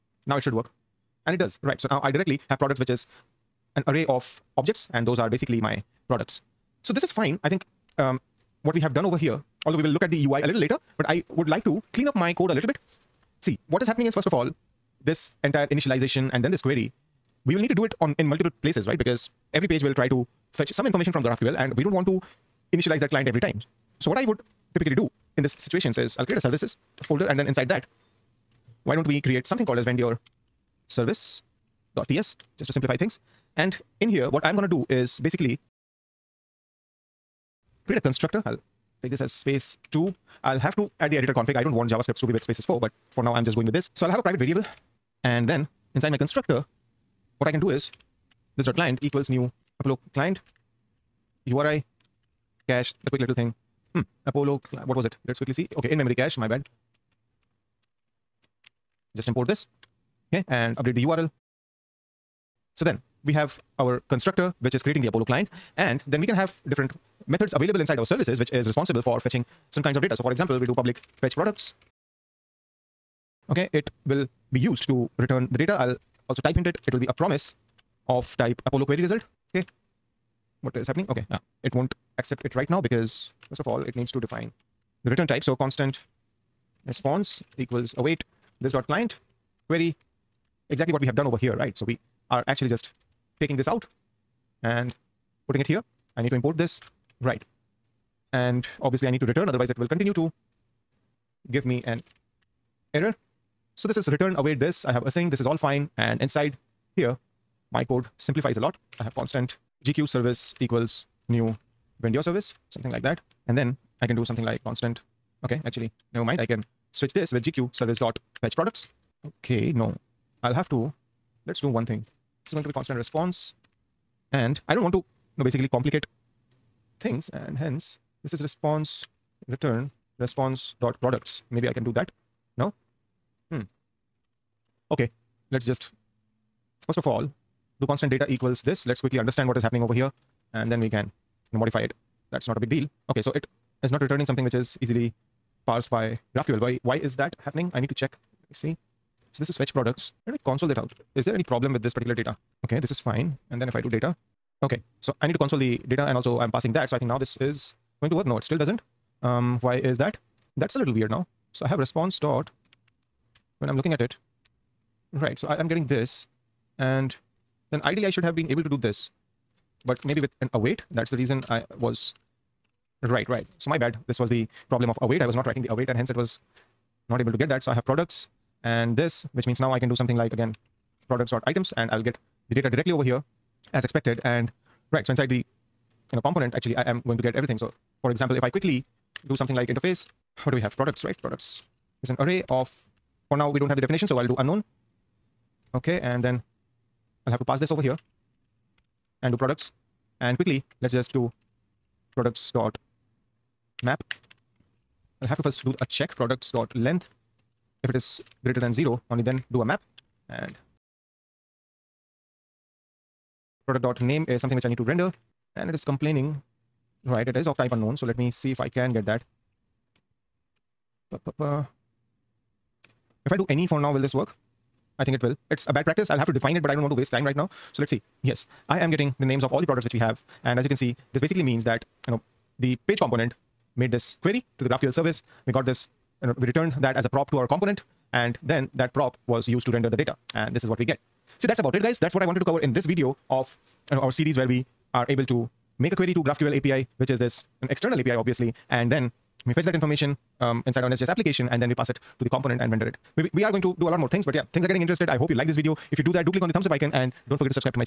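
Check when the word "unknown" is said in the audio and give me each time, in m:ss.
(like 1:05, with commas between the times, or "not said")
3:14, 3:37.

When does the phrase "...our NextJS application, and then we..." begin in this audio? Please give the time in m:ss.
4:10.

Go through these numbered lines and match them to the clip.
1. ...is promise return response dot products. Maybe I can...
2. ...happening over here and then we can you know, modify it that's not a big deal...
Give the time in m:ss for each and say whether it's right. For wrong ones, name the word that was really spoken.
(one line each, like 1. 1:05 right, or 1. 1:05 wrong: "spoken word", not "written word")
1. 2:08 wrong: "response", not "promise"
2. 2:19 right.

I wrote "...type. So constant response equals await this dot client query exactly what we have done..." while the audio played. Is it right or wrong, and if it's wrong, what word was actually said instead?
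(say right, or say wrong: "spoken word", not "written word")
right.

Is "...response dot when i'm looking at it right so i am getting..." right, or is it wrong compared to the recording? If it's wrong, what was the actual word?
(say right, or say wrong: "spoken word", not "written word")
right.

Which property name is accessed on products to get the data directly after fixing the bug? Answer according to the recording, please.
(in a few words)
items.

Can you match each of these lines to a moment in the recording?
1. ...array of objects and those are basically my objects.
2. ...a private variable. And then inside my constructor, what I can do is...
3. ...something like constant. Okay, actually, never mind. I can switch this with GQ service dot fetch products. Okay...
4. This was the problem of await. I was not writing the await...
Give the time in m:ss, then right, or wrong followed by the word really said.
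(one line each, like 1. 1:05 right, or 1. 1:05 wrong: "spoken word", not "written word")
1. 0:03 wrong: "products", not "objects"
2. 0:44 right
3. 1:54 right
4. 2:54 right.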